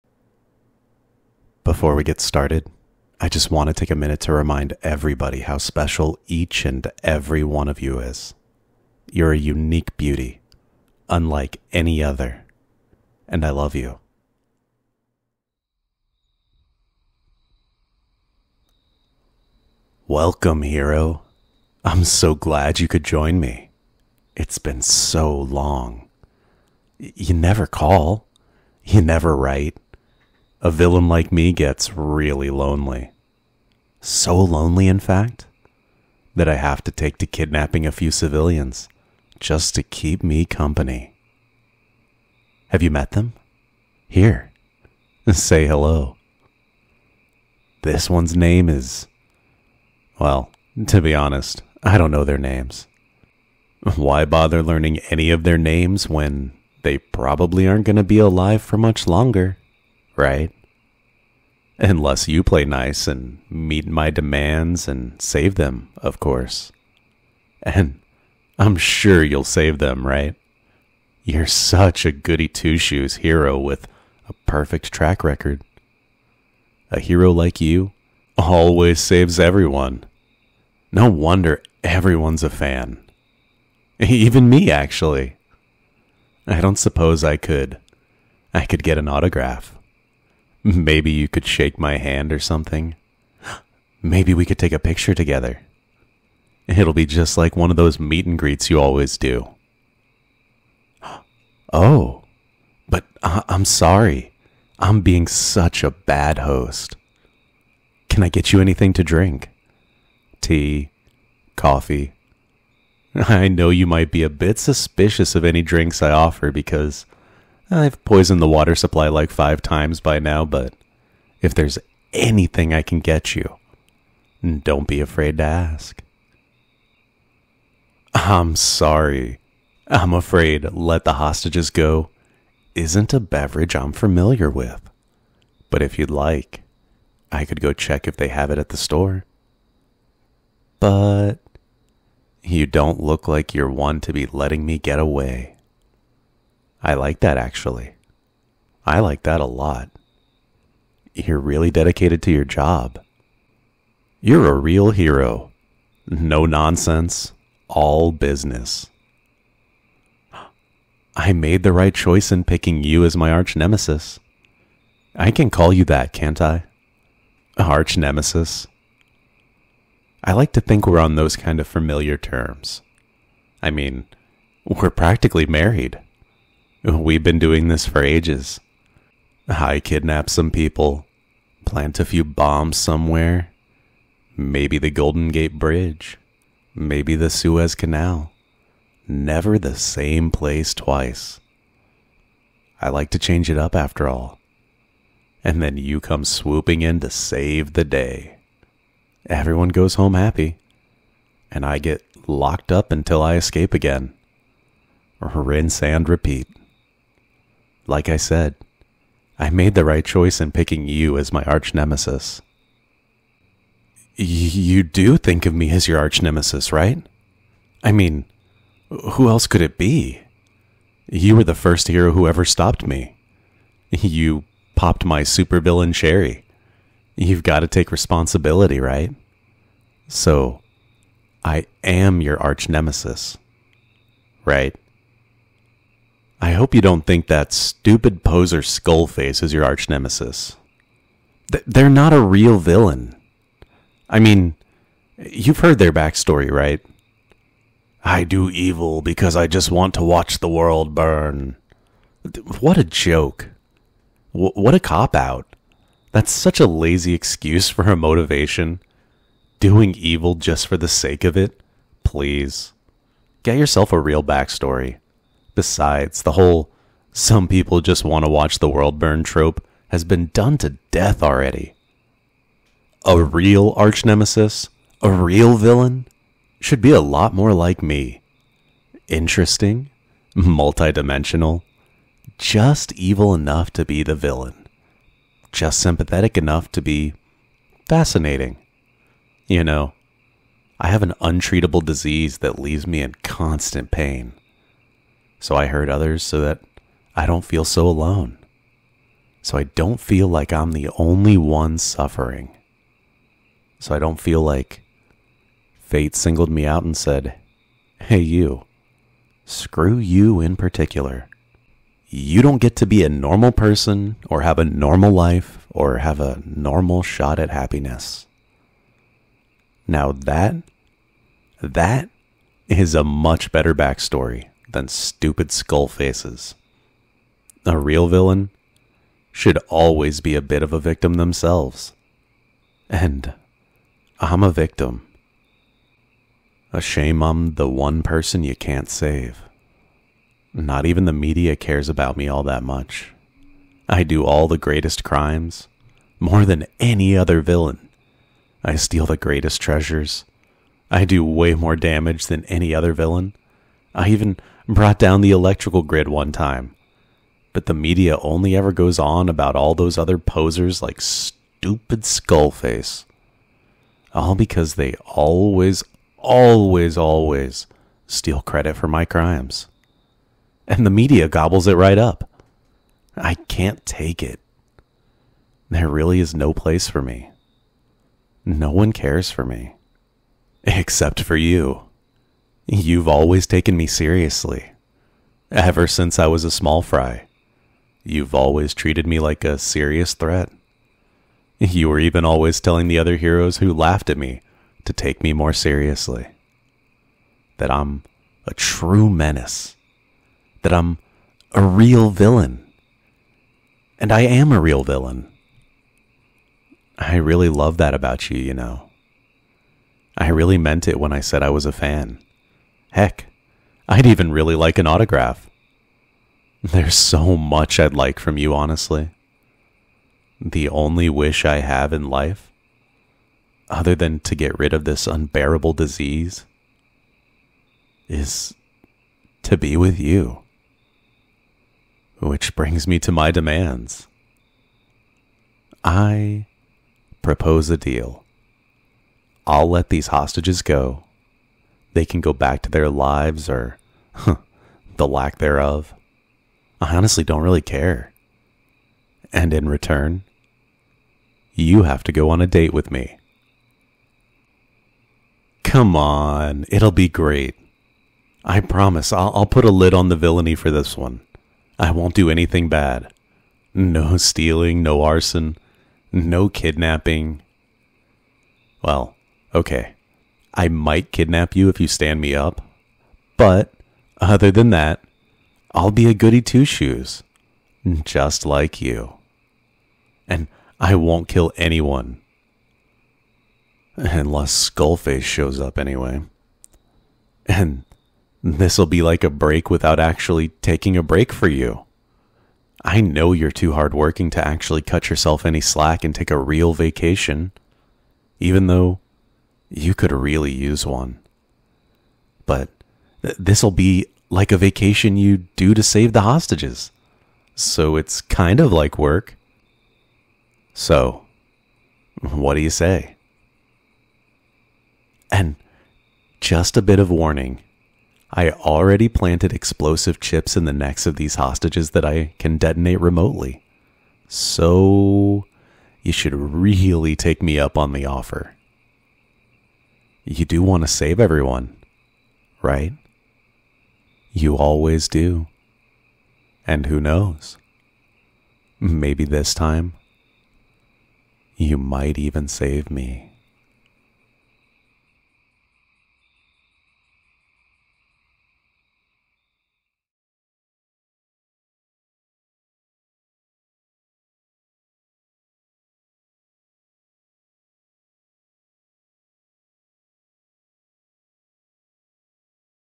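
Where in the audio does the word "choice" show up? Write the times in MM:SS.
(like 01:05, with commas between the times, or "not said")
02:41, 03:30.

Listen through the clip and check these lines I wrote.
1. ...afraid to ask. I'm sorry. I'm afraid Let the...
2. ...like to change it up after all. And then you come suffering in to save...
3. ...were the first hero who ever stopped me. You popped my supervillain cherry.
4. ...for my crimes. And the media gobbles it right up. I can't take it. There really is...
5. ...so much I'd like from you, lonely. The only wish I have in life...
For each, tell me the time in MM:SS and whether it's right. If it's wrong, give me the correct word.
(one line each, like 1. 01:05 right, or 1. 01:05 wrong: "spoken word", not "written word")
1. 02:04 right
2. 03:12 wrong: "swooping", not "suffering"
3. 03:41 right
4. 06:08 right
5. 06:56 wrong: "honestly", not "lonely".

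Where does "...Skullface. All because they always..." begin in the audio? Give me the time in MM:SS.
06:02.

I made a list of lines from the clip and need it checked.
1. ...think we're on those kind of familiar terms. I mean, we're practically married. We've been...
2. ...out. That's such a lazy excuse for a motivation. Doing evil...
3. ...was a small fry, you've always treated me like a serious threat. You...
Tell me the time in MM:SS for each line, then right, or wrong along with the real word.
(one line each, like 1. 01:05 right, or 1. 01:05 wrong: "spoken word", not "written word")
1. 02:50 right
2. 04:15 right
3. 06:26 right.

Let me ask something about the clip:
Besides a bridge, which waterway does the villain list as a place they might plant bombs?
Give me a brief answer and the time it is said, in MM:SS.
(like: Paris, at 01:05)
Suez Canal, at 03:07.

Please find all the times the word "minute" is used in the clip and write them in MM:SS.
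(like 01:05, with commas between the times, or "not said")
00:03.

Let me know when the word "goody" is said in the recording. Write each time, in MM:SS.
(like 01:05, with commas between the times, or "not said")
01:12, 07:56.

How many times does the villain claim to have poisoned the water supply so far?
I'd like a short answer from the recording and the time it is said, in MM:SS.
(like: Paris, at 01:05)
5, at 01:59.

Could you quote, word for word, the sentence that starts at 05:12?
You don't get to be a normal person or have a normal life or have a normal shot at happiness.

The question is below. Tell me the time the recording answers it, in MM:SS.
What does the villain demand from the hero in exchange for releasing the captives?
07:32.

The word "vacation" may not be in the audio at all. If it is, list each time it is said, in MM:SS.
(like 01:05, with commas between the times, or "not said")
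08:16, 08:24.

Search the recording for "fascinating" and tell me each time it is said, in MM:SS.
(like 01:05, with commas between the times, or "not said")
04:47.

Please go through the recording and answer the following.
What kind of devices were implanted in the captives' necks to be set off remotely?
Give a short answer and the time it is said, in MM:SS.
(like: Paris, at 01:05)
explosive chips, at 08:39.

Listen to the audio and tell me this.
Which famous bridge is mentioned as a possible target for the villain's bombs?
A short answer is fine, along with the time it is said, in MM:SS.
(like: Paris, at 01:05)
Golden Gate Bridge, at 03:04.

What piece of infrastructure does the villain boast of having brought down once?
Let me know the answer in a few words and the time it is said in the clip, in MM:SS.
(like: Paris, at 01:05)
the electrical grid, at 05:55.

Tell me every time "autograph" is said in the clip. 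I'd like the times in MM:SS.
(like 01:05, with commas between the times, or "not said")
01:29, 06:54.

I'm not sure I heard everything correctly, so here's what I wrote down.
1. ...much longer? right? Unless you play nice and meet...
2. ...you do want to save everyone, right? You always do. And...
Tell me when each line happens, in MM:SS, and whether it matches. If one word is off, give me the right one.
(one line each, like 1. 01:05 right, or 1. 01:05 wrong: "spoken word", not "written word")
1. 00:58 right
2. 08:50 right.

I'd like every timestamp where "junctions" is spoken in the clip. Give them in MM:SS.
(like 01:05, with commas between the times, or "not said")
not said.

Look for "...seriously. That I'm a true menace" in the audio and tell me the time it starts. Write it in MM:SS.
06:35.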